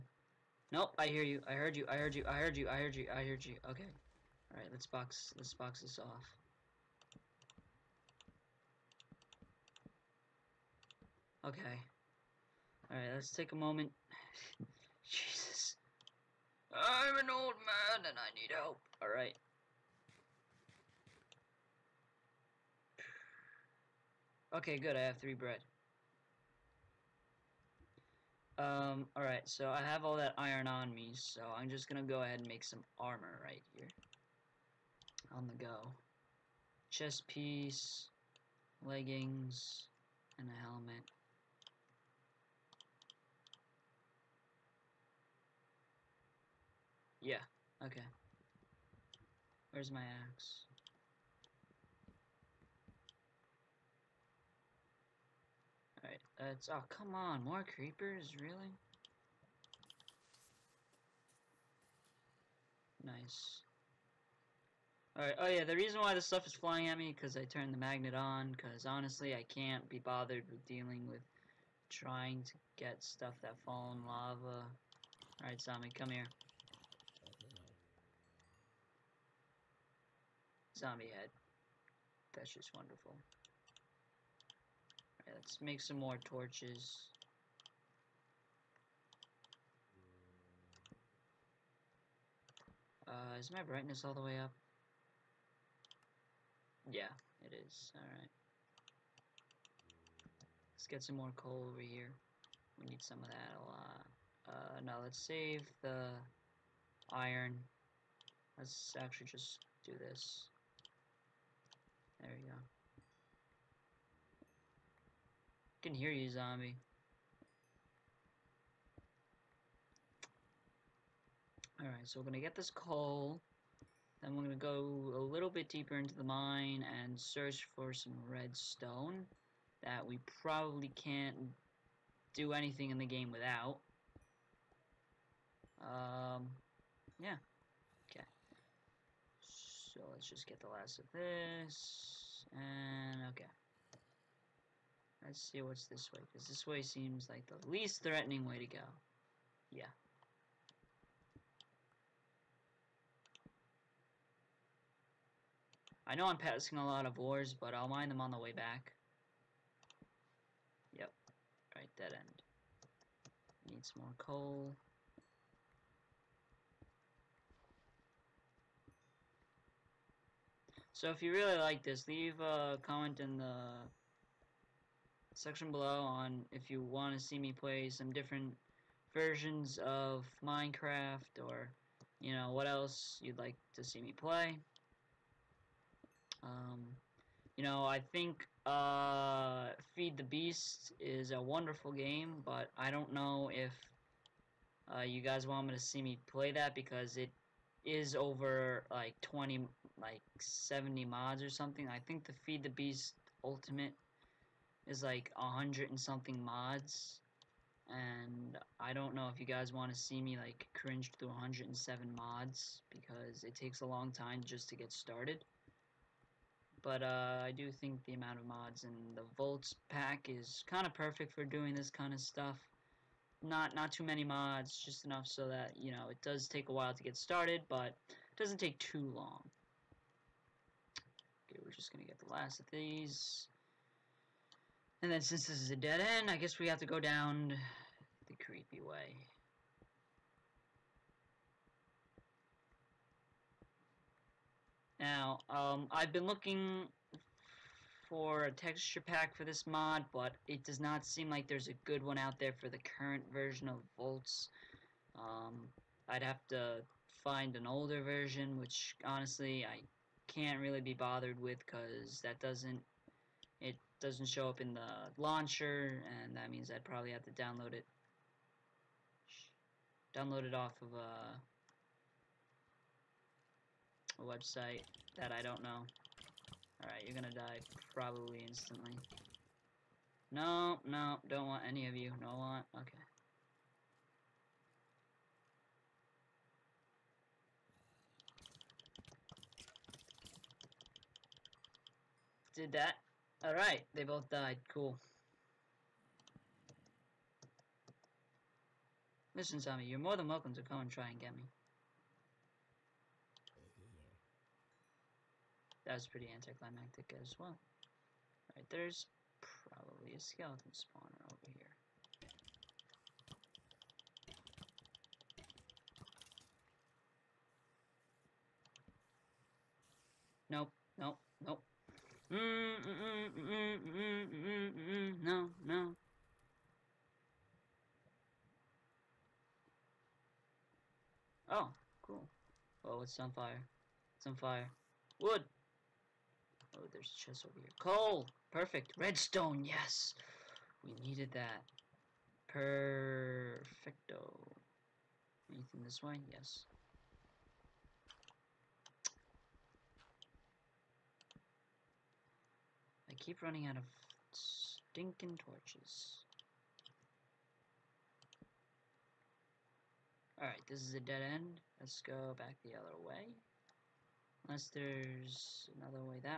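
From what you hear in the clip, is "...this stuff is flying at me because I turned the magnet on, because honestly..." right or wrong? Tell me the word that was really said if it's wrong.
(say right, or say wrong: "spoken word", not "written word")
right.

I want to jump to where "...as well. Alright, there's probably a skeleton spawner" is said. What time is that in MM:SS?
05:07.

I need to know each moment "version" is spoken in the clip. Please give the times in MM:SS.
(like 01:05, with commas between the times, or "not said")
02:59, 04:13, 04:18.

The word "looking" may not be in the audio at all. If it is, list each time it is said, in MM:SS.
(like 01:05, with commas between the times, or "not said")
04:06.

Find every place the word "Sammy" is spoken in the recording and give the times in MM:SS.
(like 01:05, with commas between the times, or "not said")
01:15.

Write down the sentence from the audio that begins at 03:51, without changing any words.
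Okay, we're just going to get the last of these.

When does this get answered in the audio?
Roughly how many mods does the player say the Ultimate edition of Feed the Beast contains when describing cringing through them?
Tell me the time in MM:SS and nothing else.
03:31.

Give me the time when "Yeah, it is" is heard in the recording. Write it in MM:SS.
01:36.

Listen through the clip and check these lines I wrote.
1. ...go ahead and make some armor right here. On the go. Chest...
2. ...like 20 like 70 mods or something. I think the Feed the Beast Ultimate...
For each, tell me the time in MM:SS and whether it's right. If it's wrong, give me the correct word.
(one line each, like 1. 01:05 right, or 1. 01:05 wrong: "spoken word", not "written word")
1. 00:32 right
2. 03:18 right.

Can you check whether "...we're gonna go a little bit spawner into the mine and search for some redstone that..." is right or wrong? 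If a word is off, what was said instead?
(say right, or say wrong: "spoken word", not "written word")
wrong: "deeper", not "spawner".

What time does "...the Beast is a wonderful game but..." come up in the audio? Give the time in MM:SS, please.
03:10.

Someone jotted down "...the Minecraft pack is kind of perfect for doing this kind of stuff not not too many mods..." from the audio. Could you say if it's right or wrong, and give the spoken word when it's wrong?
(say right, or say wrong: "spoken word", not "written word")
wrong: "Voltz", not "Minecraft".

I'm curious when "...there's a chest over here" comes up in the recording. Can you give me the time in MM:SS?
05:36.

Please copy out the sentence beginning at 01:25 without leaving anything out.
Alright, let's make some more torches.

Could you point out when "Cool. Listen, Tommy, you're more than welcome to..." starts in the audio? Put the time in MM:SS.
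04:54.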